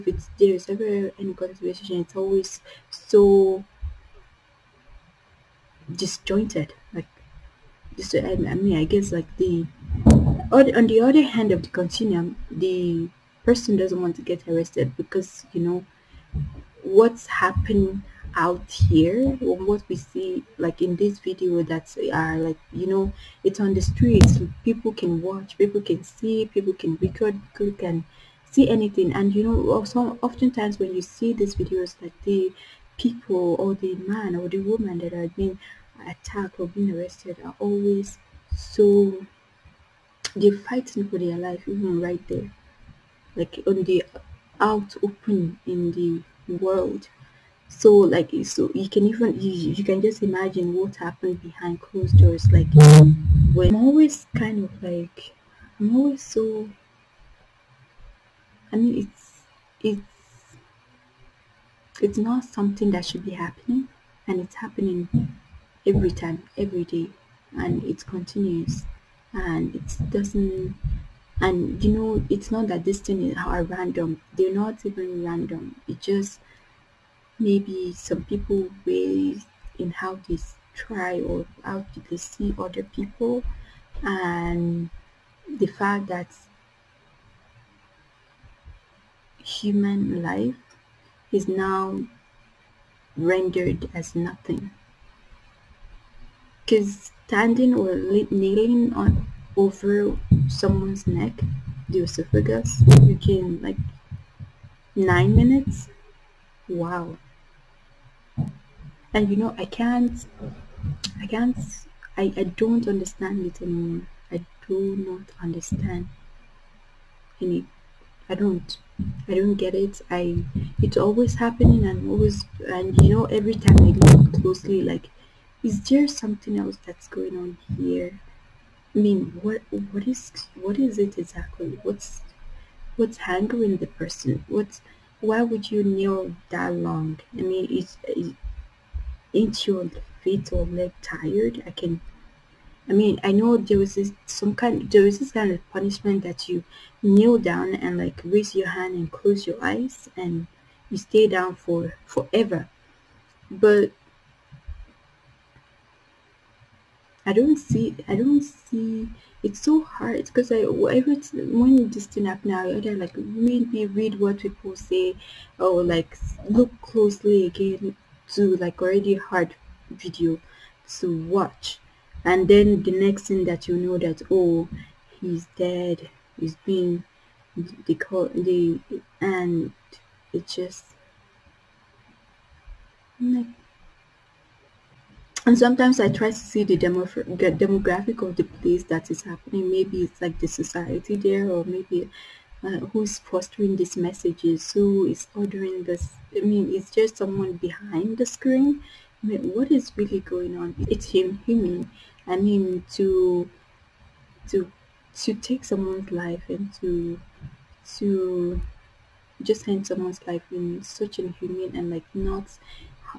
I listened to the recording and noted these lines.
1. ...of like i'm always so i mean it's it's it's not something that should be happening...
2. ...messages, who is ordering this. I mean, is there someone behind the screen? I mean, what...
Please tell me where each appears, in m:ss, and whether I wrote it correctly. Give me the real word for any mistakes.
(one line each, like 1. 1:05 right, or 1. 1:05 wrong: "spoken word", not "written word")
1. 0:54 right
2. 3:13 right.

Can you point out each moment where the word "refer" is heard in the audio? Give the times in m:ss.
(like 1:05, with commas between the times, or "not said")
not said.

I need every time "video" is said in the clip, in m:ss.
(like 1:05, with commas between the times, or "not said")
0:21, 0:31, 2:49.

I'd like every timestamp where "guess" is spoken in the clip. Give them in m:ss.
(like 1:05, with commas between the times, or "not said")
0:08.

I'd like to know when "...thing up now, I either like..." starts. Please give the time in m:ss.
2:42.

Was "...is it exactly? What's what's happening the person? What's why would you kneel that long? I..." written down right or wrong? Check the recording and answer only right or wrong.
wrong.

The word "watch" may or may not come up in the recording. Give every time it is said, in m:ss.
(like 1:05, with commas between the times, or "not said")
0:25, 2:51.